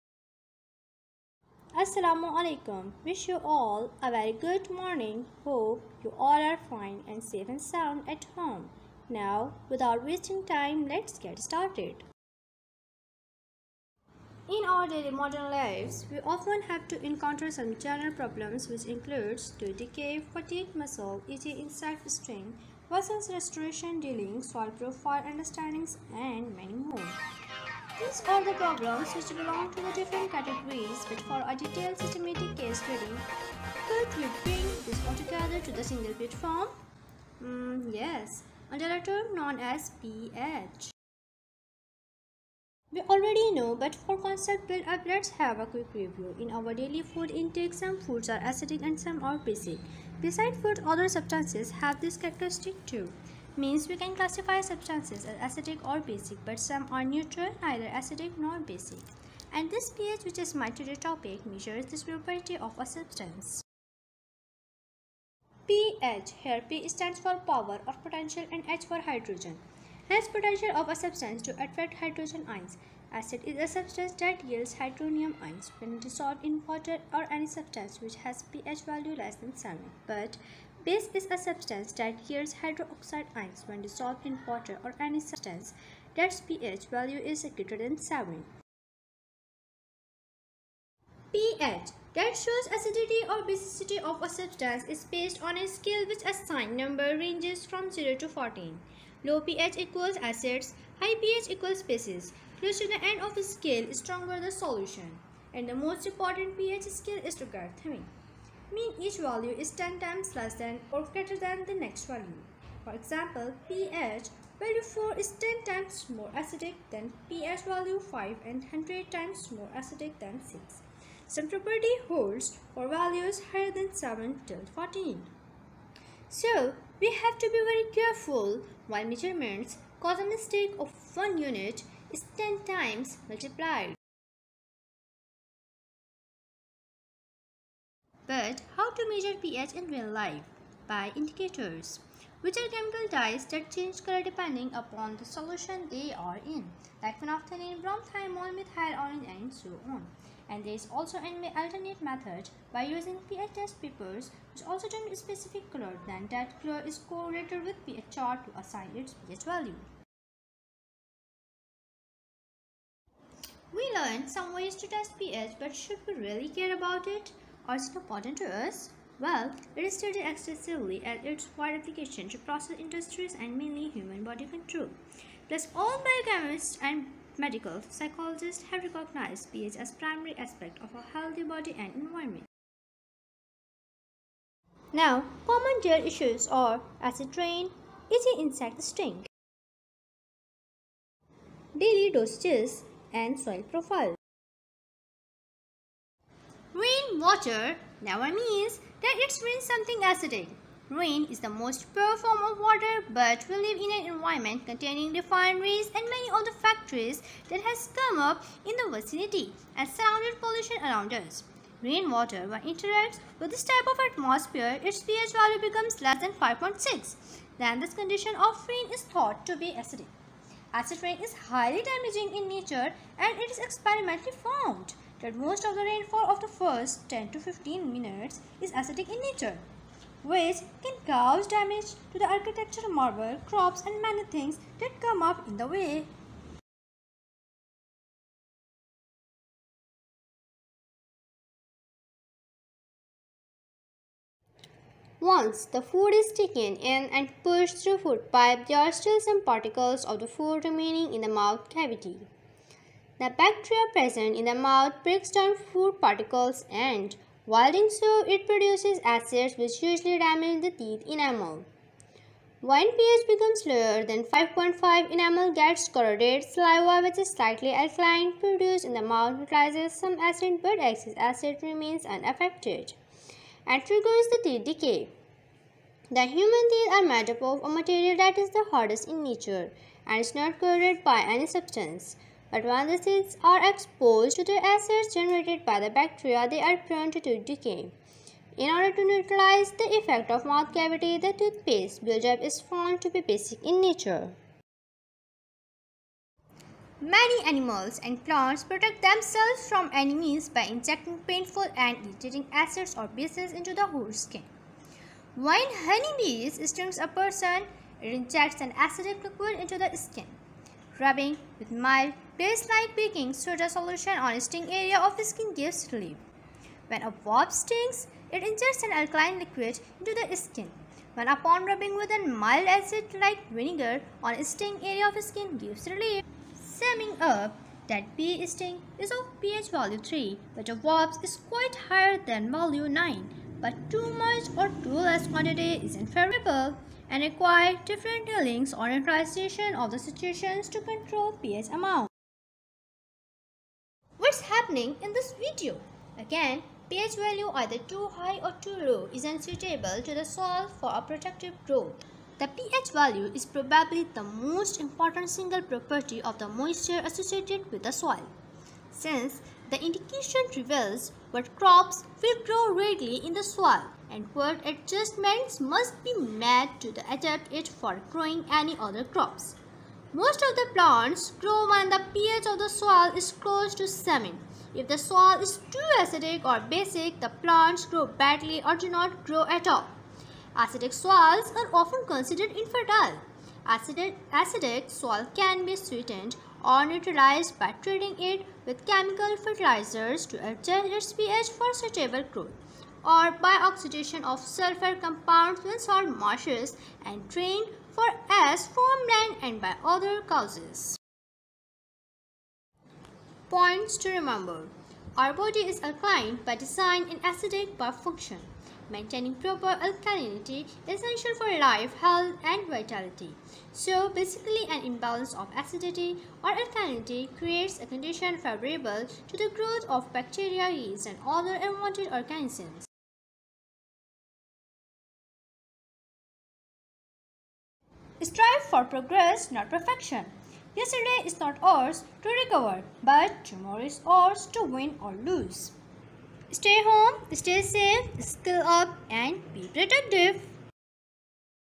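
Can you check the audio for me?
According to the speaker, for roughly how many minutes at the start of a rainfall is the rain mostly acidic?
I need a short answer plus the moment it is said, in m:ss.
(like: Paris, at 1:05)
10 to 15 minutes, at 3:47.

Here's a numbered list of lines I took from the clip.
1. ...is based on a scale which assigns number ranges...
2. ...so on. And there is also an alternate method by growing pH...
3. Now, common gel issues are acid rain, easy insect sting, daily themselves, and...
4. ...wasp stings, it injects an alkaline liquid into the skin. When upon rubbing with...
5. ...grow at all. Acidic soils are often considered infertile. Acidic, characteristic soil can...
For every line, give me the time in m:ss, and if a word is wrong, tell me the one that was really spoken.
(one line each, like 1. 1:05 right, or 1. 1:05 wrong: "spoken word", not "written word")
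1. 1:34 right
2. 2:29 wrong: "using", not "growing"
3. 3:04 wrong: "dosages", not "themselves"
4. 5:17 right
5. 6:19 wrong: "acidic", not "characteristic".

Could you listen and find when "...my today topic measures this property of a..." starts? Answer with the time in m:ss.
1:00.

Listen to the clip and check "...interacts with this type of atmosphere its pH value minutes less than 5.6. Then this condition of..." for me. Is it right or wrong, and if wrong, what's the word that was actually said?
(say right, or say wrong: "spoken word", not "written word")
wrong: "becomes", not "minutes".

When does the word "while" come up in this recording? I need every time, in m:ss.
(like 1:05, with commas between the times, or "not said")
2:08, 4:17.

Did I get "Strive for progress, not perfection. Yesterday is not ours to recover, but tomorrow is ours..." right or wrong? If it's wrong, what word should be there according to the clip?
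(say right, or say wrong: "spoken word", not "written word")
right.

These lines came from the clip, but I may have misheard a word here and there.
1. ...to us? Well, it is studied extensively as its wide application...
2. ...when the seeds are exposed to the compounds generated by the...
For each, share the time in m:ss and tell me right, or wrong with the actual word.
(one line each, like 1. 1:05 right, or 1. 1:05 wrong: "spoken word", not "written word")
1. 2:48 right
2. 4:42 wrong: "acids", not "compounds".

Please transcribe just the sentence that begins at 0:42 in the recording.
We already know but for concept build-up let's have a quick review.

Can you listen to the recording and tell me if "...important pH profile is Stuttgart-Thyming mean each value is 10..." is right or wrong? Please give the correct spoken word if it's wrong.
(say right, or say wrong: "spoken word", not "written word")
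wrong: "scale", not "profile".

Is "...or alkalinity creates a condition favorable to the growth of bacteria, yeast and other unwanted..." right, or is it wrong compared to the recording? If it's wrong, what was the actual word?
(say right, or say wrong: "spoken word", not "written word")
right.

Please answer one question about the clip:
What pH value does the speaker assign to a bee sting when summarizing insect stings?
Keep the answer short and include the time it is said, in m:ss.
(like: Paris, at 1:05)
3, at 5:29.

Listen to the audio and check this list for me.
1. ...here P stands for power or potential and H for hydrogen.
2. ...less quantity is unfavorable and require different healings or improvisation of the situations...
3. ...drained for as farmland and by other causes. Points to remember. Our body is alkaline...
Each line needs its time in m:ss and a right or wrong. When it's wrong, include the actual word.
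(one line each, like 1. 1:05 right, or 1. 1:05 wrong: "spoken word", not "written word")
1. 1:06 right
2. 5:35 right
3. 6:37 right.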